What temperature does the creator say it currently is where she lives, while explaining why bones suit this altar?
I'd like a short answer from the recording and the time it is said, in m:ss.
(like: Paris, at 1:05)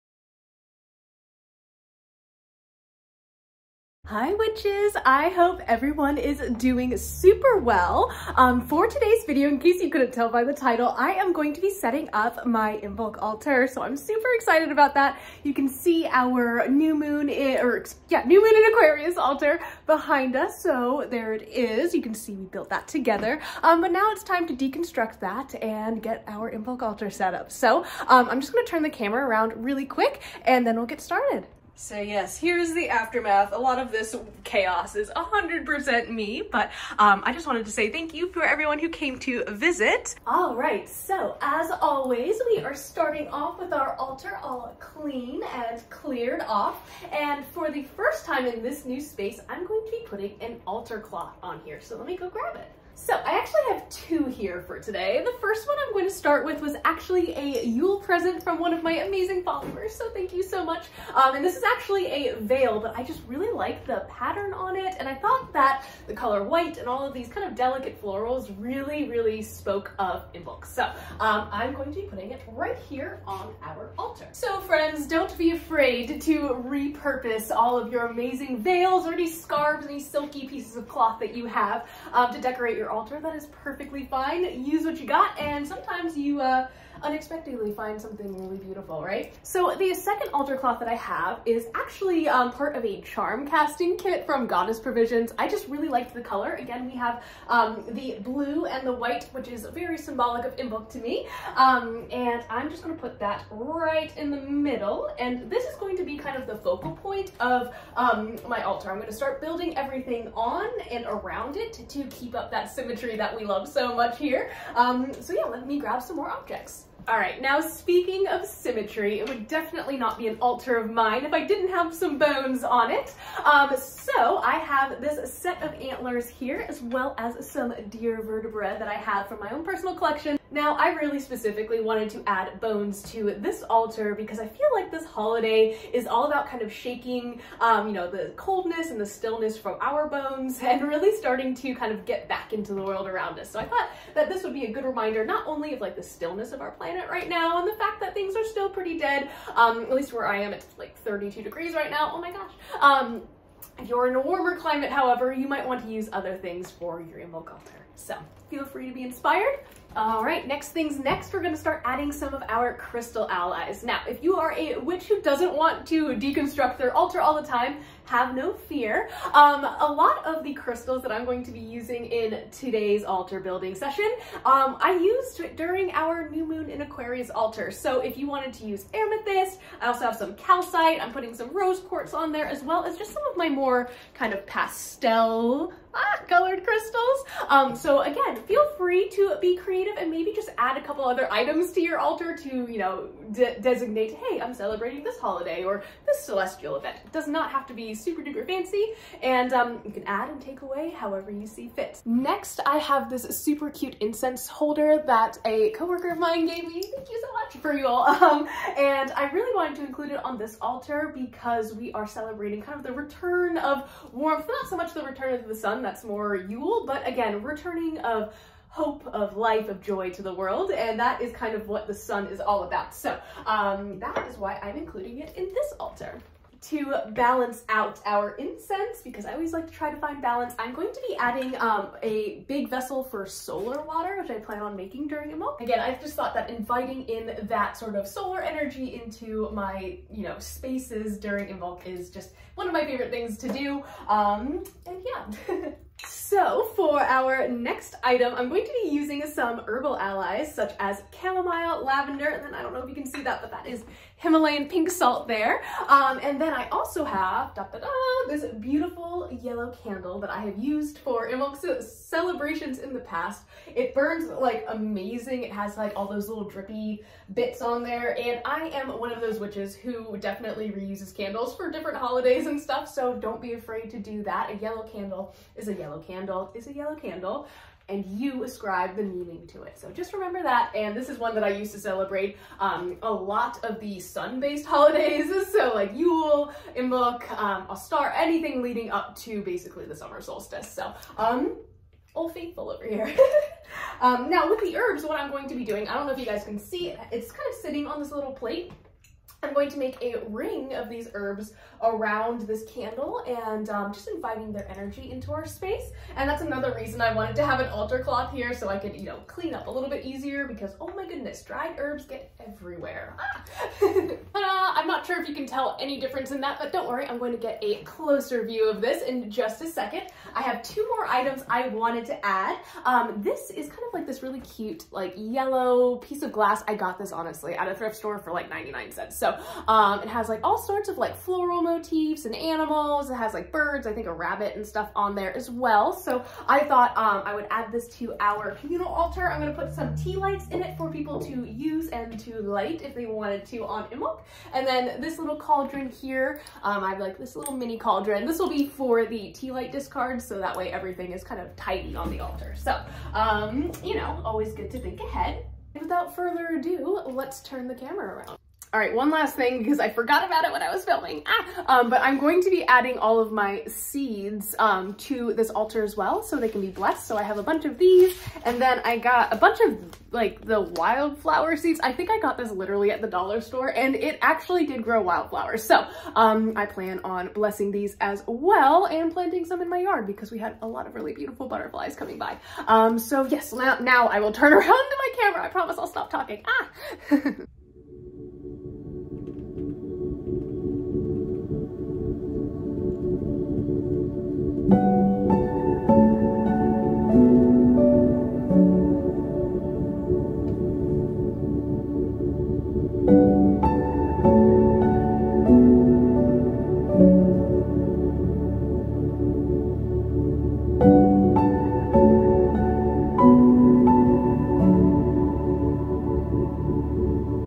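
32 degrees, at 2:30.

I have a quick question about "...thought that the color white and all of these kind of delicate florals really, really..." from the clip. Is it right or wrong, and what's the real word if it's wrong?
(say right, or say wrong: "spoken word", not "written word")
right.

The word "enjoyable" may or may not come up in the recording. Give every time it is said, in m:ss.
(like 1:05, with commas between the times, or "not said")
not said.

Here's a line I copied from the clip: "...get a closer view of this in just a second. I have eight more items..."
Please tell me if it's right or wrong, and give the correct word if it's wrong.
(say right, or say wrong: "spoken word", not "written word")
wrong: "two", not "eight".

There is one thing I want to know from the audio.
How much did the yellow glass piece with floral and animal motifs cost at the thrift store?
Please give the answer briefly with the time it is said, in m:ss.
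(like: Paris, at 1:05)
99 cents, at 5:28.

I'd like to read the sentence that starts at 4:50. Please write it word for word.
So um, all faithful over here.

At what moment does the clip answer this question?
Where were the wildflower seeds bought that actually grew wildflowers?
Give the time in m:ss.
6:13.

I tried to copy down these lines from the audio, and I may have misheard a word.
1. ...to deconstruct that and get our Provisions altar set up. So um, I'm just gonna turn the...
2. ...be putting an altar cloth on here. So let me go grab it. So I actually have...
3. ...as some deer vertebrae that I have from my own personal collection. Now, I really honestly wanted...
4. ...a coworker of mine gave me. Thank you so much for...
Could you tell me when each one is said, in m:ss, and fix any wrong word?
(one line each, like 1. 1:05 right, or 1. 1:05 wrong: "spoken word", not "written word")
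1. 0:24 wrong: "Imbolc", not "Provisions"
2. 0:49 right
3. 2:07 wrong: "specifically", not "honestly"
4. 3:25 right.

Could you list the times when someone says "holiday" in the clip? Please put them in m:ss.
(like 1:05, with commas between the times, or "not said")
2:15, 3:15, 4:31, 4:44.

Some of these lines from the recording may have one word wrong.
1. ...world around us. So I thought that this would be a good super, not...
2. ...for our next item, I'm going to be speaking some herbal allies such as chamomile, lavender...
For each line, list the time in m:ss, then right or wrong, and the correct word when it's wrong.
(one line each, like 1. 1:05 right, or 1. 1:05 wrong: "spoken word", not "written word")
1. 2:22 wrong: "reminder", not "super"
2. 4:06 wrong: "using", not "speaking".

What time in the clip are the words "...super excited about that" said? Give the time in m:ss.
0:13.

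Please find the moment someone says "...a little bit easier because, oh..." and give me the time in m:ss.
5:09.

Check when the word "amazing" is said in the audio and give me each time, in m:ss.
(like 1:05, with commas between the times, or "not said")
0:59, 1:18, 4:24.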